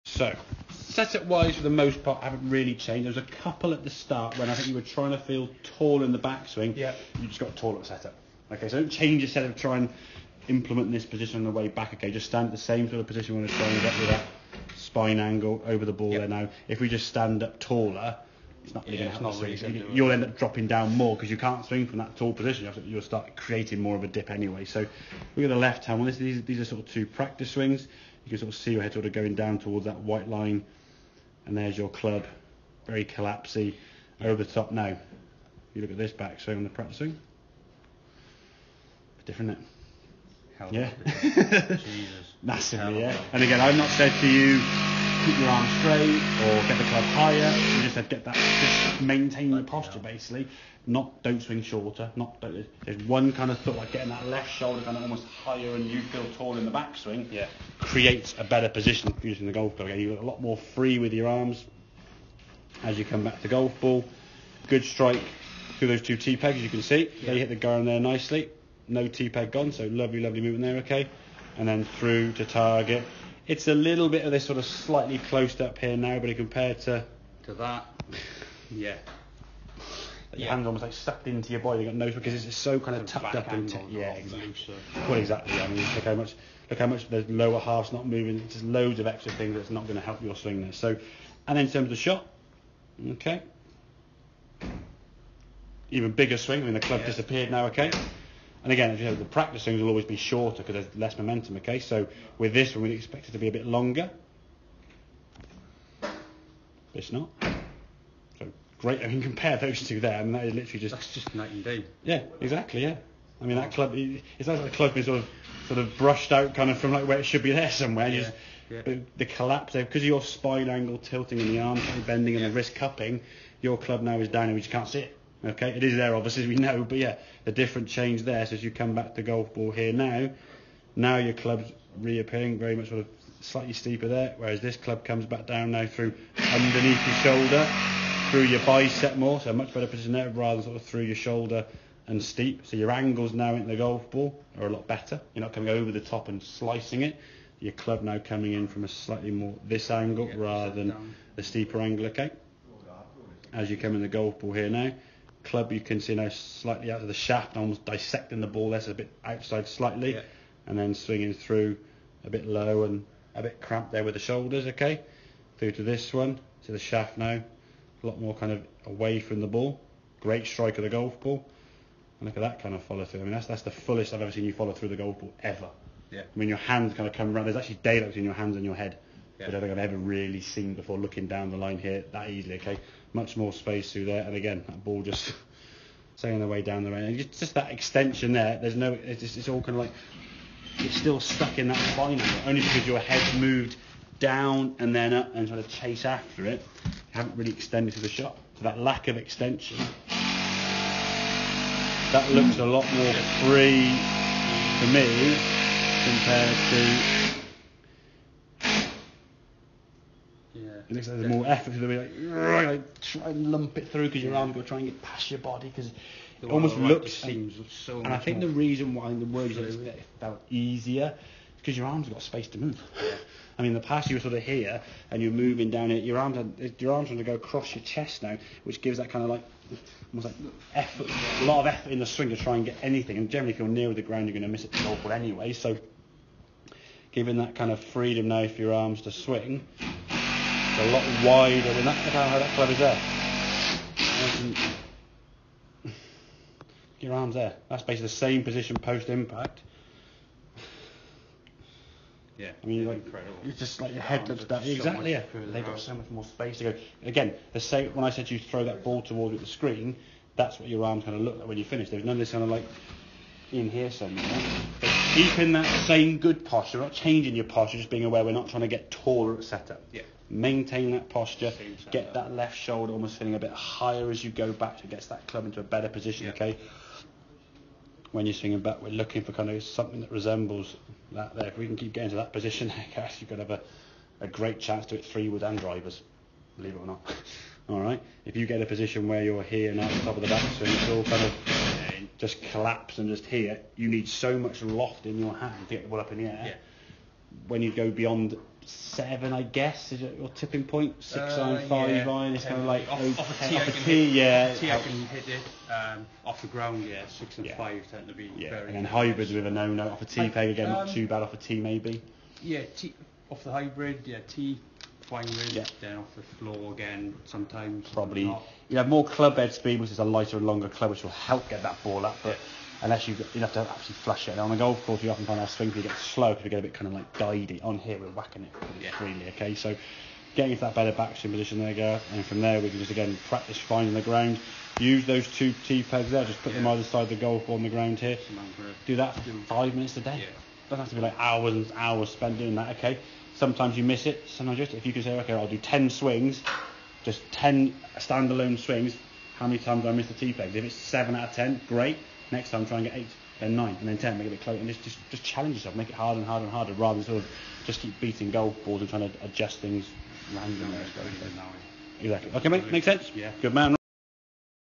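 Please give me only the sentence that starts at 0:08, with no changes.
Okay, so don't change your setup.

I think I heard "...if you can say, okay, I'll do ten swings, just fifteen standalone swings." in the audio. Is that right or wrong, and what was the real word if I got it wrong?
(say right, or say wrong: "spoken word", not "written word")
wrong: "ten", not "fifteen".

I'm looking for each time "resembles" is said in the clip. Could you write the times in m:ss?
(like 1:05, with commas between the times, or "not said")
4:40.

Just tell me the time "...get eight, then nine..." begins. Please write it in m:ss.
5:52.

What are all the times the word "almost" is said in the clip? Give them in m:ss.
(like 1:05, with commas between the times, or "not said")
0:55, 1:20, 2:37, 3:36, 3:50, 4:32.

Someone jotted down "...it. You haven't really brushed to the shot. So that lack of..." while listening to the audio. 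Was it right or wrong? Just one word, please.
wrong.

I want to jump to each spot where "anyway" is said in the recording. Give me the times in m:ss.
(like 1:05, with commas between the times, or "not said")
0:24, 3:55.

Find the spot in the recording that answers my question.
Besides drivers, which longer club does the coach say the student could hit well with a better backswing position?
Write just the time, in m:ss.
4:45.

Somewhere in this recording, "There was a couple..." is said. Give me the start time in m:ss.
0:03.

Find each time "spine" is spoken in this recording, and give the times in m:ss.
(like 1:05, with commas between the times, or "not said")
0:14, 2:00.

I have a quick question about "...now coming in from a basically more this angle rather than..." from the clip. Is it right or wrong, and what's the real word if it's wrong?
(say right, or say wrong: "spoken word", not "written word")
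wrong: "slightly", not "basically".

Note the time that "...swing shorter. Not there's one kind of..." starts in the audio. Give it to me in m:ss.
0:51.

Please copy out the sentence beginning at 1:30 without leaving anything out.
So, and then in terms of the shot, okay, even bigger swing.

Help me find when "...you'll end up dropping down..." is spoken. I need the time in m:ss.
0:19.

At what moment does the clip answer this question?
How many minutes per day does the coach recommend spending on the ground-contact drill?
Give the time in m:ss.
5:39.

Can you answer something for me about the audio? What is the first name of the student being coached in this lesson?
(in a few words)
Gareth.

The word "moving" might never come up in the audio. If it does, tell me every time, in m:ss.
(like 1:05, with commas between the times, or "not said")
1:28, 3:45.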